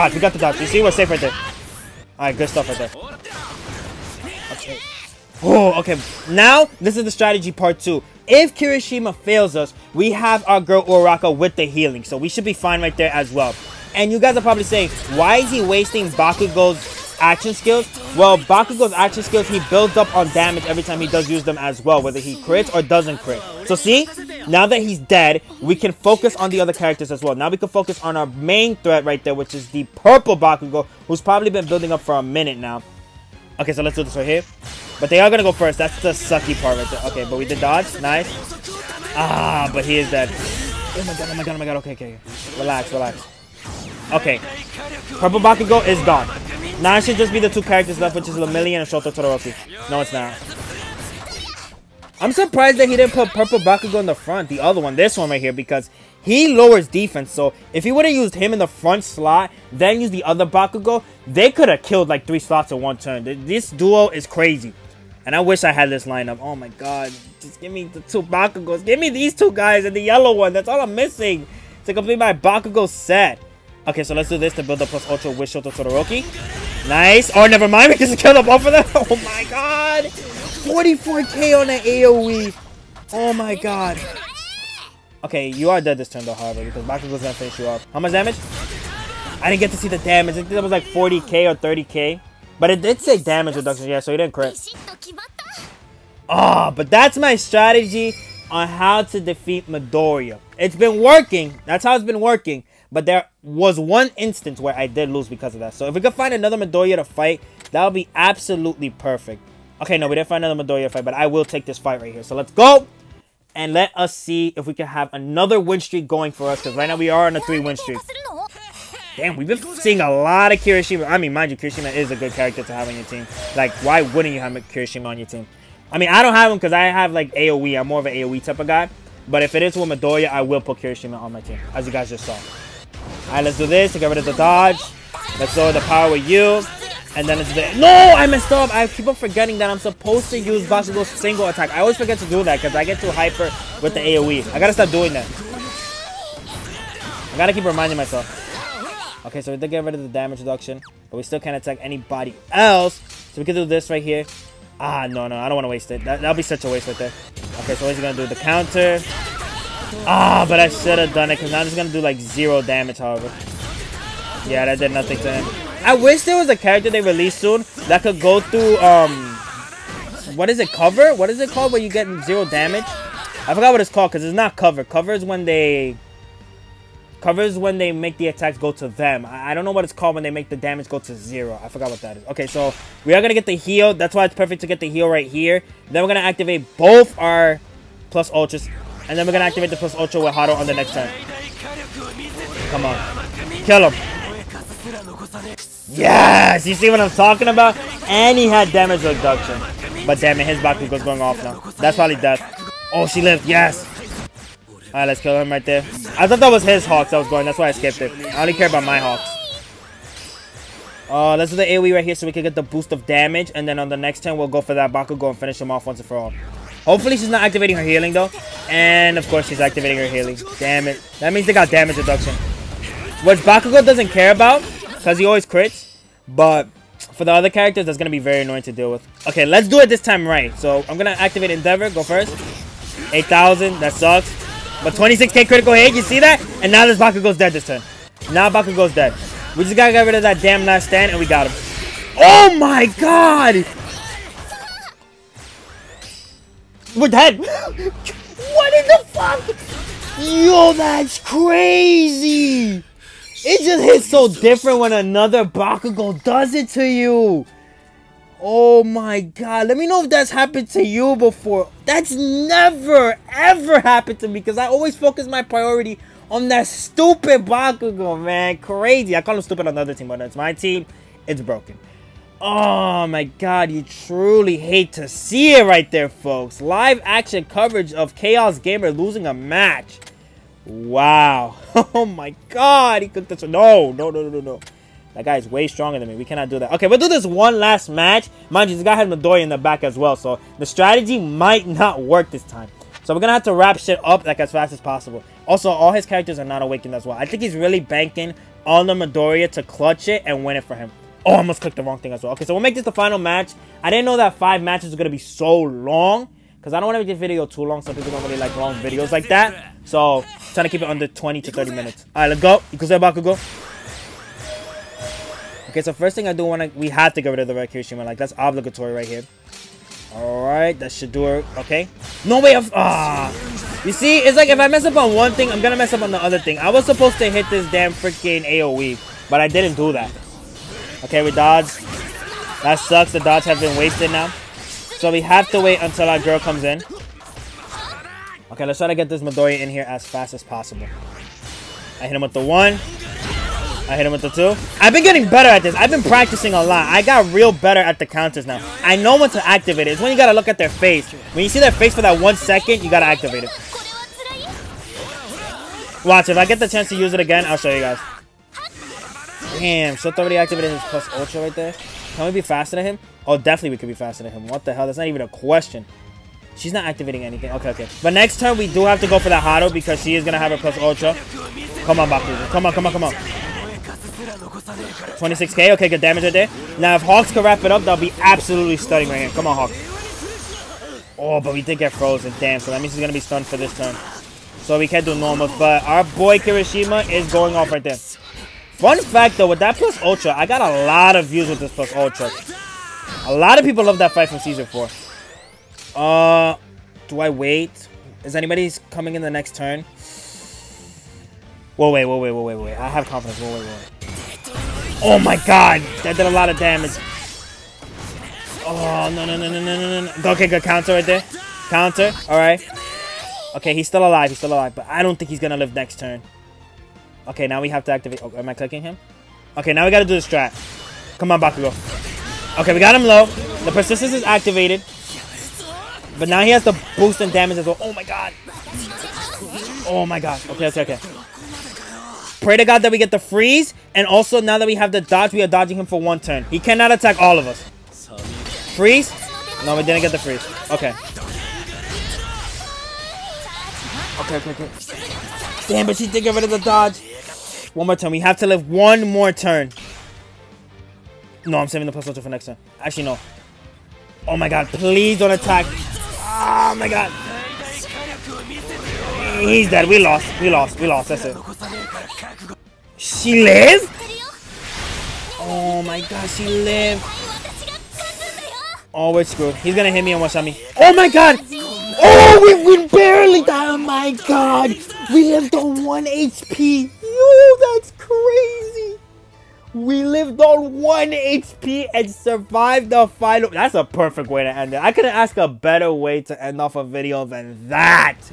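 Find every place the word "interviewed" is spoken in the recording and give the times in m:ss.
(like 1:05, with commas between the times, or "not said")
not said.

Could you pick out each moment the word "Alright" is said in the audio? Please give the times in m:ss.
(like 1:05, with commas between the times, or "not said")
0:02, 3:24, 6:52.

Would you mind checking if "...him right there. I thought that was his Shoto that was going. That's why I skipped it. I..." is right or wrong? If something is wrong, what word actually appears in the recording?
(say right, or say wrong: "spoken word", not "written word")
wrong: "Hawks", not "Shoto".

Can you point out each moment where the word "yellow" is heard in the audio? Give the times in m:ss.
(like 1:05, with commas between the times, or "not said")
1:10.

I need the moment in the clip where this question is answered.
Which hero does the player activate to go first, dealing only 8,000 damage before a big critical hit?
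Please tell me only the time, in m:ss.
3:51.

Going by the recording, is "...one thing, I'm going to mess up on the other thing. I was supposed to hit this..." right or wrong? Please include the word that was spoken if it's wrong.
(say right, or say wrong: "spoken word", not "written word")
right.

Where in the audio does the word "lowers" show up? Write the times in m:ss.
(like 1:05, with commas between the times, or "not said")
0:56, 2:15.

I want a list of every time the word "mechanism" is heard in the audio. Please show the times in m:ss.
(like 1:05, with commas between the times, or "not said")
not said.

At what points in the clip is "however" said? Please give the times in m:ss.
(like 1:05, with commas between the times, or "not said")
1:26, 2:42.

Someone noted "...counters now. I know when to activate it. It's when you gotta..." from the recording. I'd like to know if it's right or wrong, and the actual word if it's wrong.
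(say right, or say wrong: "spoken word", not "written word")
right.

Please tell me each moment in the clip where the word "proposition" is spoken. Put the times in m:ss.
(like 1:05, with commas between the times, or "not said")
not said.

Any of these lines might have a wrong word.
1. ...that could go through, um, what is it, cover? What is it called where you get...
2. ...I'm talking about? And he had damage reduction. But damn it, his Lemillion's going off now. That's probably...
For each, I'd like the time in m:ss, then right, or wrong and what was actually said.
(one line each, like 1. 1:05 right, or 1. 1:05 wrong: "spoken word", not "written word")
1. 2:47 right
2. 3:17 wrong: "Bakugo", not "Lemillion".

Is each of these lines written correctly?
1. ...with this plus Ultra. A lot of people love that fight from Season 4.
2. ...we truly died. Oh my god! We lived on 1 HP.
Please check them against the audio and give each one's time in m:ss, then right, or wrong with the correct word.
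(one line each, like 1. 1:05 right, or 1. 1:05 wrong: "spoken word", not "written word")
1. 6:31 right
2. 7:52 wrong: "barely", not "truly".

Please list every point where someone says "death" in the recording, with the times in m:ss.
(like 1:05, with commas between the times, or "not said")
3:22.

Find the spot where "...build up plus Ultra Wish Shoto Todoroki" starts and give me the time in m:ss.
1:14.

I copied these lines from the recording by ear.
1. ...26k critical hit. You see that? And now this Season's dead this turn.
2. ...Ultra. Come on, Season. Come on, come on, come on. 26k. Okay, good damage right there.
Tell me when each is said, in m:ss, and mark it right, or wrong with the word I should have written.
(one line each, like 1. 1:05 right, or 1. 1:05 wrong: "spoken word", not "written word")
1. 3:54 wrong: "Bakugo", not "Season"
2. 6:10 wrong: "Bakugo", not "Season".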